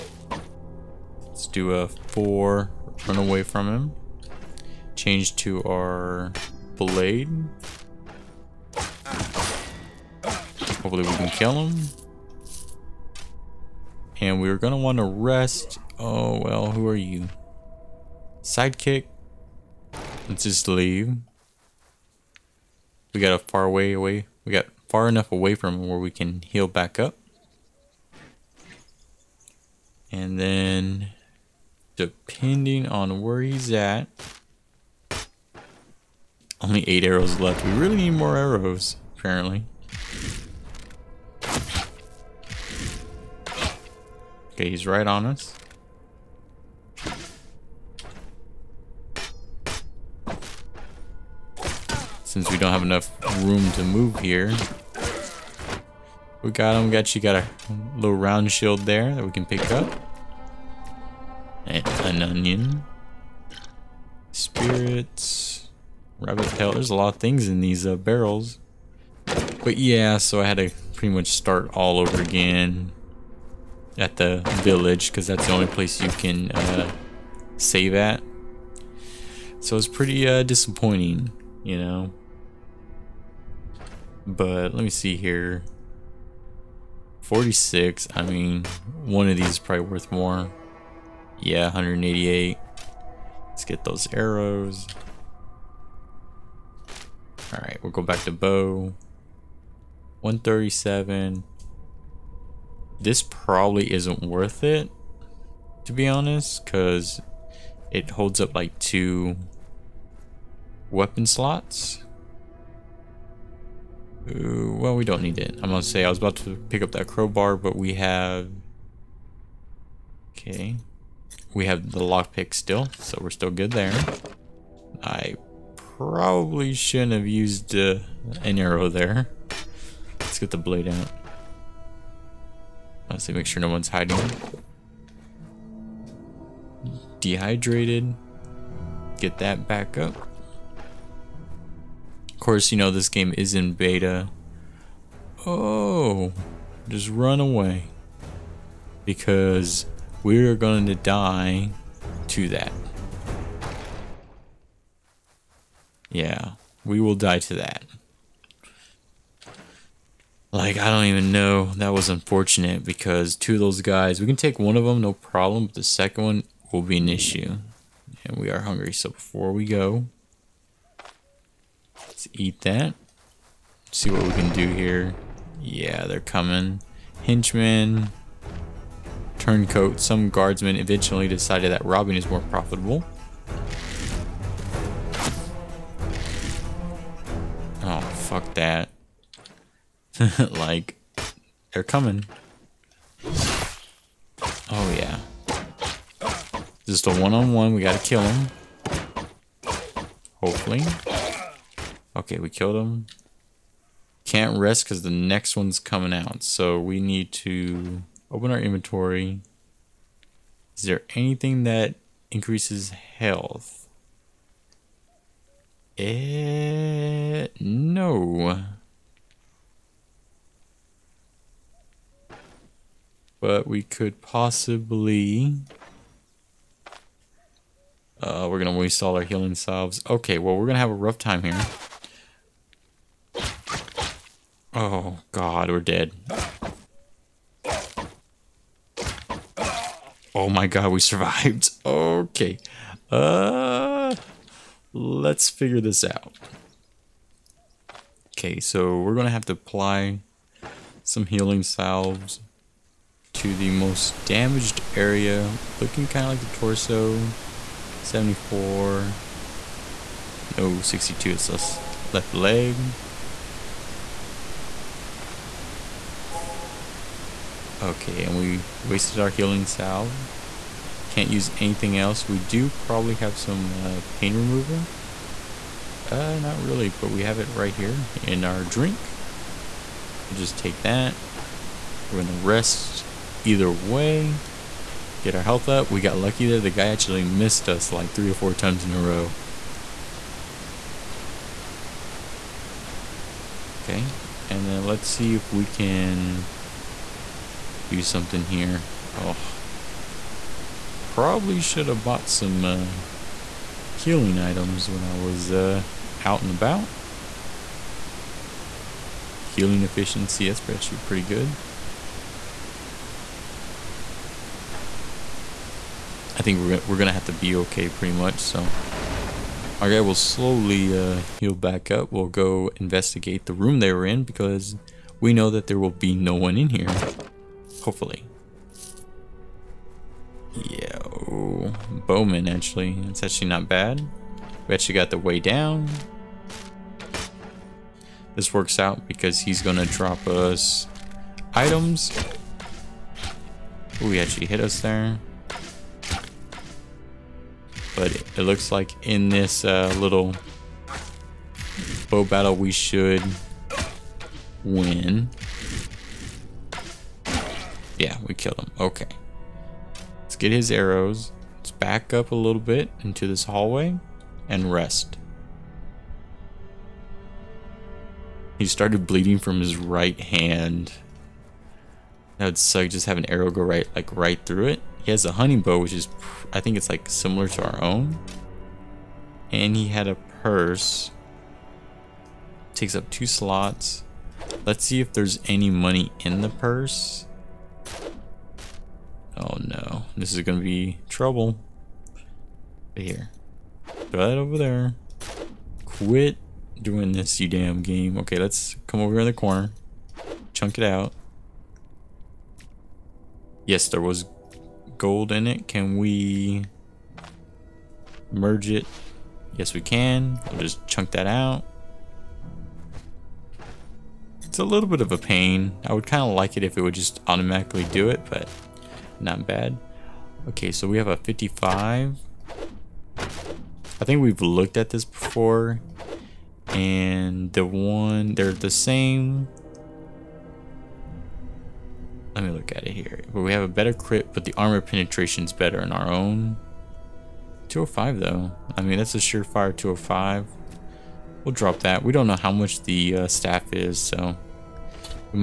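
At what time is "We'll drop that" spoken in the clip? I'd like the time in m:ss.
7:21.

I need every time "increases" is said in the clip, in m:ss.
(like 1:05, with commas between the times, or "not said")
3:32.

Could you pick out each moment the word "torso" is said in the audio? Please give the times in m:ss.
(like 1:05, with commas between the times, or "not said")
4:16.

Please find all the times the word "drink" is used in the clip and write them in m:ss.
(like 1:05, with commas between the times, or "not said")
4:38.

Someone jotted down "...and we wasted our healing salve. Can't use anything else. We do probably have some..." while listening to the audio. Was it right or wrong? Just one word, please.
right.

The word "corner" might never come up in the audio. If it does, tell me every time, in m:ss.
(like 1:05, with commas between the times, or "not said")
6:39.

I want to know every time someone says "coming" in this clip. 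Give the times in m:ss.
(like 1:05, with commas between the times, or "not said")
2:56, 3:11, 3:25.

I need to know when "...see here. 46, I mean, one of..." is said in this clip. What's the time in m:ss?
1:24.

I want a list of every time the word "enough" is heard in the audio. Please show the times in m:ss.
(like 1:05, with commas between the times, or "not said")
0:25, 0:52.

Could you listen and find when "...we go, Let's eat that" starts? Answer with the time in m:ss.
2:49.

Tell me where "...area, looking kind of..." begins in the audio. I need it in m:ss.
4:14.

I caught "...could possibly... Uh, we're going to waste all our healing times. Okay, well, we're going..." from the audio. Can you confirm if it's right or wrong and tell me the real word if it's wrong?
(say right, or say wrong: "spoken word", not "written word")
wrong: "salves", not "times".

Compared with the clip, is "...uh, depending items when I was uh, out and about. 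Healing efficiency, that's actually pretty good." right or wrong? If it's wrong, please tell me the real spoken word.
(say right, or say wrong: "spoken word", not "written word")
wrong: "healing", not "depending".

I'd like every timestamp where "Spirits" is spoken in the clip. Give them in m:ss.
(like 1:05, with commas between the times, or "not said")
1:04.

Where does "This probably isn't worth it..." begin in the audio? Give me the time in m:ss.
1:43.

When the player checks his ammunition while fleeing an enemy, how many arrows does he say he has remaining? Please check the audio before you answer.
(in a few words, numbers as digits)
8.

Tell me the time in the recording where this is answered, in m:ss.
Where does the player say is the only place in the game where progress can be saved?
1:14.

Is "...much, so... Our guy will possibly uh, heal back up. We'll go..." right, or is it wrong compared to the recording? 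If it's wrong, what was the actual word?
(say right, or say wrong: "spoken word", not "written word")
wrong: "slowly", not "possibly".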